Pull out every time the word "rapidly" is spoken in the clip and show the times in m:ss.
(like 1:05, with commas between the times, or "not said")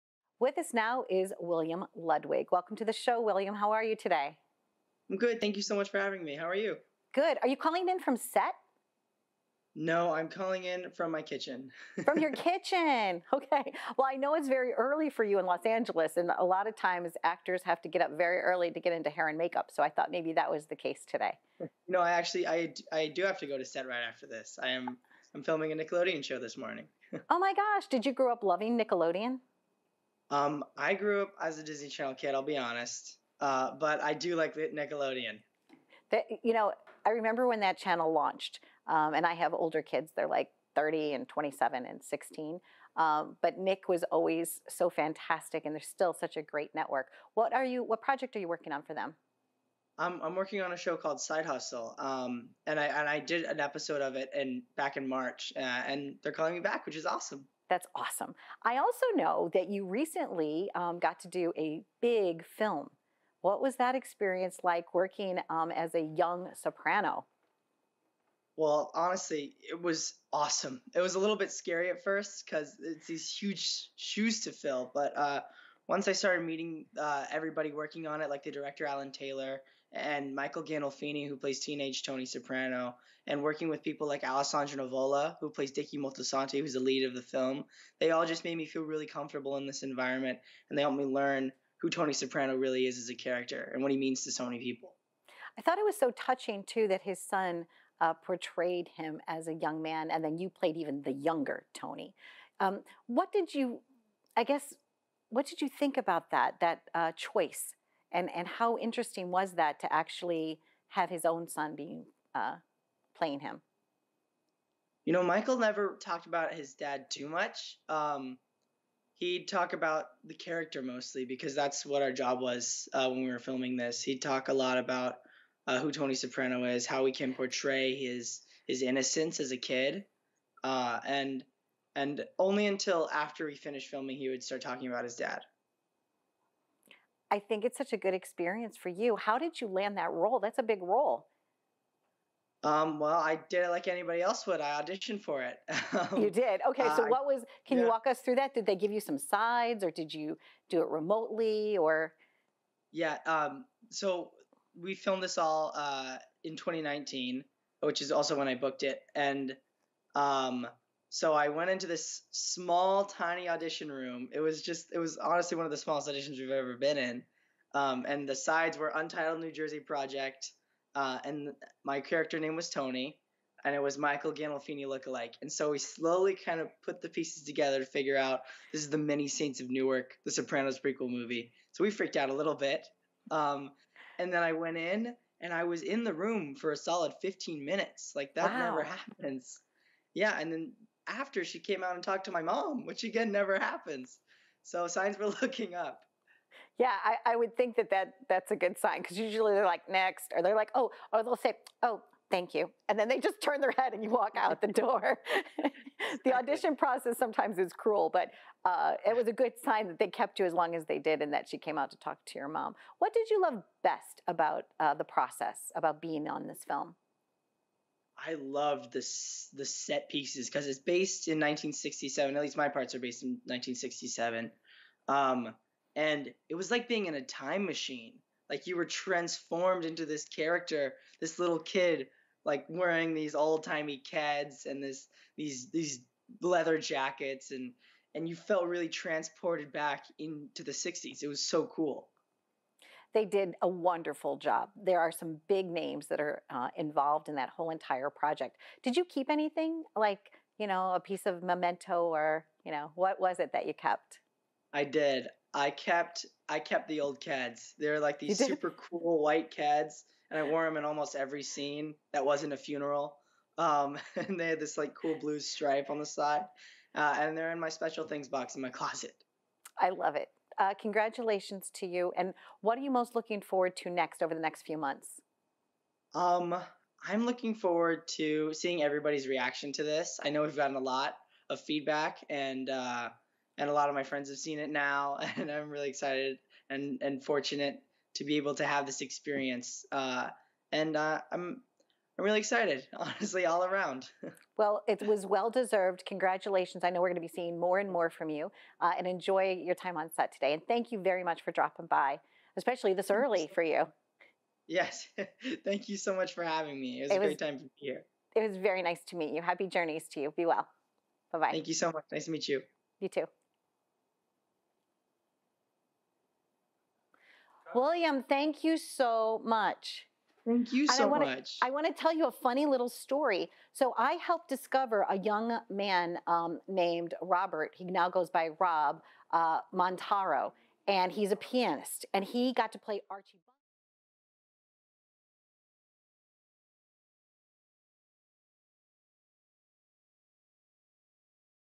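not said.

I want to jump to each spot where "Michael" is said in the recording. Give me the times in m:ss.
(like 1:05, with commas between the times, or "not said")
1:20, 1:55, 2:53.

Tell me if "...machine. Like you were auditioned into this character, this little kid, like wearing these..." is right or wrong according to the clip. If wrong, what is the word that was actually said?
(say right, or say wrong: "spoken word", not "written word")
wrong: "transformed", not "auditioned".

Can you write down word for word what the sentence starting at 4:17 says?
They're like these super cool white Keds and I wore them in almost every scene that wasn't a funeral.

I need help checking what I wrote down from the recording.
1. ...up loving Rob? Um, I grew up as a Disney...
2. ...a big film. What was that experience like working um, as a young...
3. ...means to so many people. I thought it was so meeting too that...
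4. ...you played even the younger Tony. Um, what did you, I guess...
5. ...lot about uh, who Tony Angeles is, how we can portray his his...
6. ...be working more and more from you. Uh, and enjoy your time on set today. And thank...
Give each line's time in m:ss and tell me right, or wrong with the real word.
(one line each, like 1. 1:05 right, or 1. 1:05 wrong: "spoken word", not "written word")
1. 0:28 wrong: "Nickelodeon", not "Rob"
2. 1:01 right
3. 1:33 wrong: "touching", not "meeting"
4. 1:40 right
5. 2:04 wrong: "Soprano", not "Angeles"
6. 4:57 wrong: "seeing", not "working".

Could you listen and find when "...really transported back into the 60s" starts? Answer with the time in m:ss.
3:58.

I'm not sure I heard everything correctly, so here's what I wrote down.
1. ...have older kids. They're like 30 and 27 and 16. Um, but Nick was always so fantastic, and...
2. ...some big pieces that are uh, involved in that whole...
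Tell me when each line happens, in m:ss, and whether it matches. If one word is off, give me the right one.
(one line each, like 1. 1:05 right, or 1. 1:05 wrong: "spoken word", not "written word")
1. 0:39 right
2. 4:05 wrong: "names", not "pieces".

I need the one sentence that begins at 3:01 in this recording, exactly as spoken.
So we freaked out a little bit.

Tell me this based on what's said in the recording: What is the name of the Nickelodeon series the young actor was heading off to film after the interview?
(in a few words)
Side Hustle.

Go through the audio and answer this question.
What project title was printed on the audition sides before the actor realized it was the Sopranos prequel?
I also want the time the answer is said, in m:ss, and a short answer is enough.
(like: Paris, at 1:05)
Untitled New Jersey Project, at 2:48.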